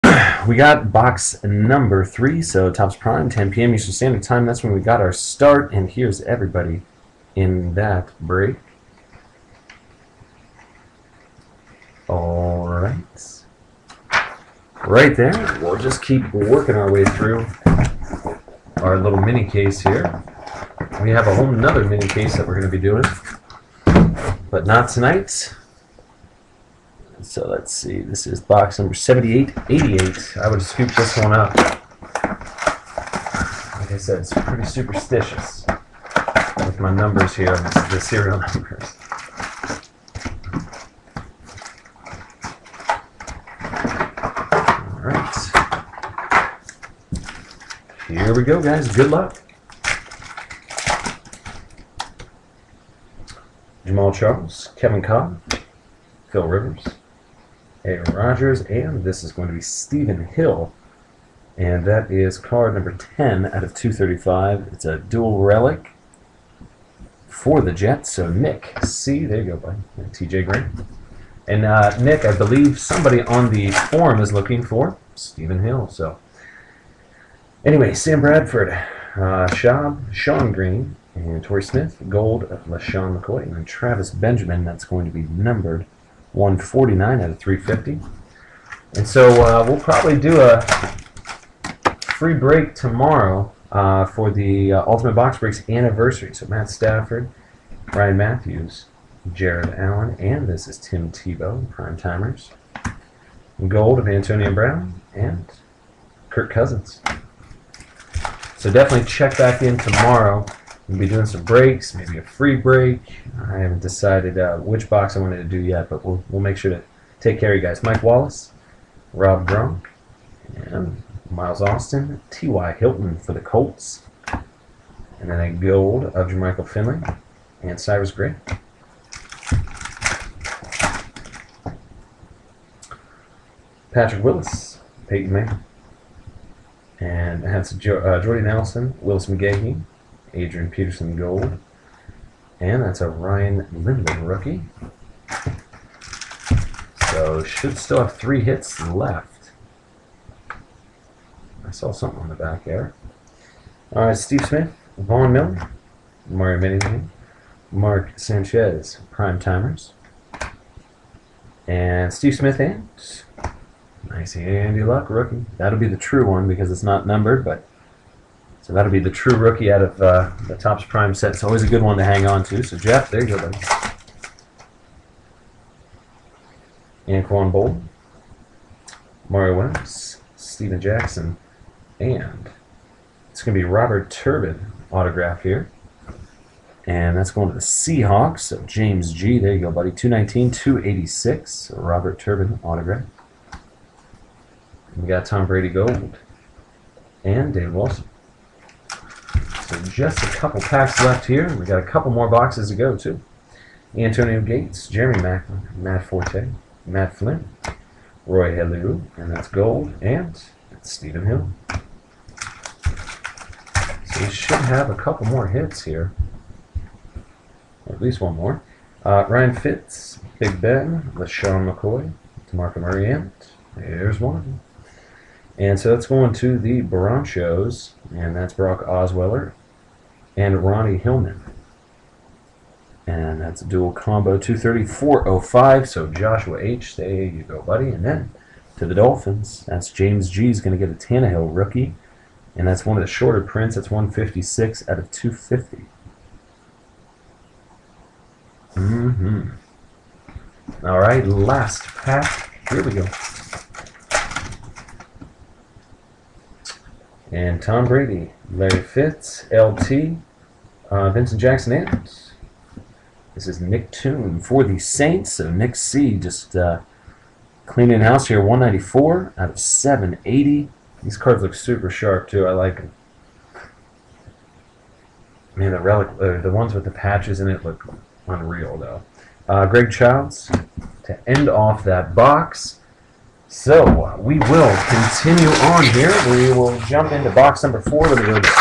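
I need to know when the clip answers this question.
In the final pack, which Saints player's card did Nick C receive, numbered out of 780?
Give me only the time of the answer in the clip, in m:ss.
4:23.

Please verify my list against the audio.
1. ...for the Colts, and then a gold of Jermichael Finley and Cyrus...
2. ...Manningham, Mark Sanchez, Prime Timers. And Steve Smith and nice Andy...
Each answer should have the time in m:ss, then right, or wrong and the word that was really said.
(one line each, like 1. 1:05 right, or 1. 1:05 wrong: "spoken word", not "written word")
1. 2:03 right
2. 2:36 right.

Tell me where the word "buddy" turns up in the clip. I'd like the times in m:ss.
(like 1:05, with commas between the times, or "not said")
1:09, 2:53, 3:09, 3:57.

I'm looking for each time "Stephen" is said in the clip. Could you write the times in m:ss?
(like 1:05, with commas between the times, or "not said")
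0:59, 1:15, 3:30.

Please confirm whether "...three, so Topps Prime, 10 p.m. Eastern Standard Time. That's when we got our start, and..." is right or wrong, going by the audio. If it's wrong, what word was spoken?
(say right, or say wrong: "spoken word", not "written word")
right.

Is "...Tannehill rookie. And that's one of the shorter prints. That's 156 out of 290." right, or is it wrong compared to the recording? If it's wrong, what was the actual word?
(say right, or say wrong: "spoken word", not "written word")
wrong: "250", not "290".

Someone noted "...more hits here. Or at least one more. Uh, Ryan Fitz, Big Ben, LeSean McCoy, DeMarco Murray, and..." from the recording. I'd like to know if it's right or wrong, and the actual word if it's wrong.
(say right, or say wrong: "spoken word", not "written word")
right.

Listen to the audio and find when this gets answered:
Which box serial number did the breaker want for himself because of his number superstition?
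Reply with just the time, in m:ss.
0:28.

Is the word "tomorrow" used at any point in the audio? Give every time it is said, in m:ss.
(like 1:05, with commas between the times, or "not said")
1:32, 1:49.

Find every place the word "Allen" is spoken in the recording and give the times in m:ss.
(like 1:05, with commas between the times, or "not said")
1:39.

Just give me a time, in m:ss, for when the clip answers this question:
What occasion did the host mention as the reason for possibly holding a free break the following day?
1:34.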